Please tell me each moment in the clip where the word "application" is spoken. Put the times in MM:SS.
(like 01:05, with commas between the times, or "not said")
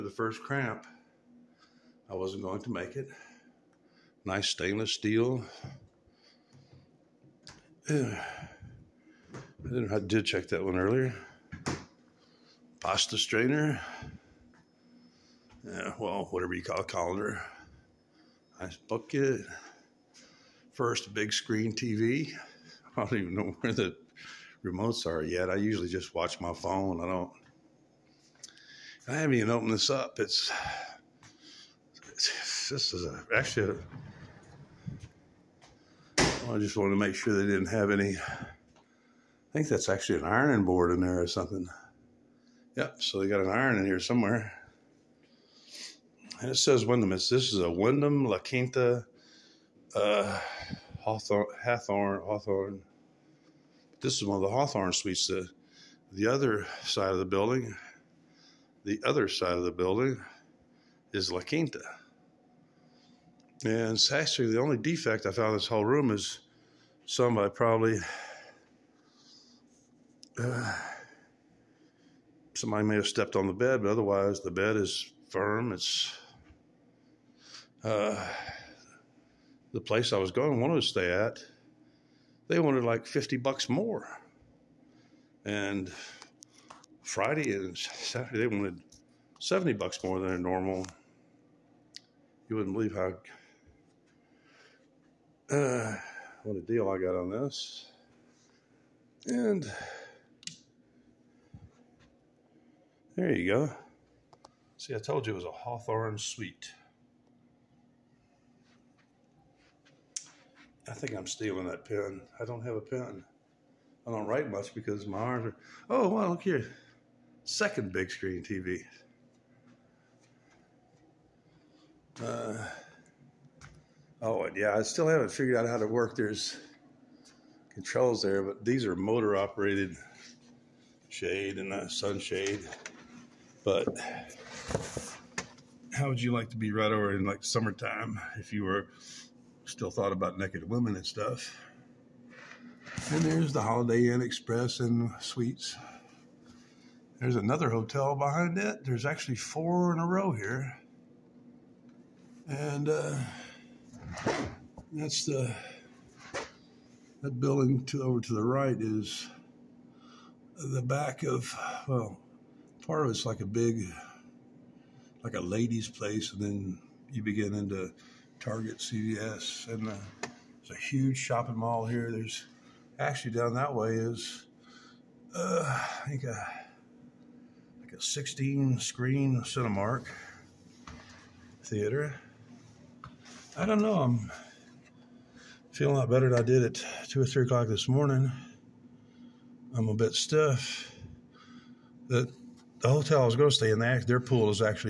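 not said.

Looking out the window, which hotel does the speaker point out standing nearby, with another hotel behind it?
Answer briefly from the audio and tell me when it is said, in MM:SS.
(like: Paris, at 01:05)
Holiday Inn Express and Suites, at 02:23.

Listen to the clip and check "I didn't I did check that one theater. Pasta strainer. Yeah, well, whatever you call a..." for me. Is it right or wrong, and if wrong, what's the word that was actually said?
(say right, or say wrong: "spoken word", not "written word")
wrong: "earlier", not "theater".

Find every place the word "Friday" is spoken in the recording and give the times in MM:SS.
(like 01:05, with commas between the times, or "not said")
01:27.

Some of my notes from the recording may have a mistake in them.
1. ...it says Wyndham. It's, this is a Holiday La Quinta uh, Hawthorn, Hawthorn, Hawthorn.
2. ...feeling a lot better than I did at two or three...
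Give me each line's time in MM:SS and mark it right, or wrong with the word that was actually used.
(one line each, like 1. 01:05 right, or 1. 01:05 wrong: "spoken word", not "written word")
1. 00:46 wrong: "Wyndham", not "Holiday"
2. 03:05 right.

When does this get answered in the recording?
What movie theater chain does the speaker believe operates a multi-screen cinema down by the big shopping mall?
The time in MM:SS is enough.
02:59.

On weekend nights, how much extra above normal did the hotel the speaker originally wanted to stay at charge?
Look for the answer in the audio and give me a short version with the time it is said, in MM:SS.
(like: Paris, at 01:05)
70 bucks, at 01:29.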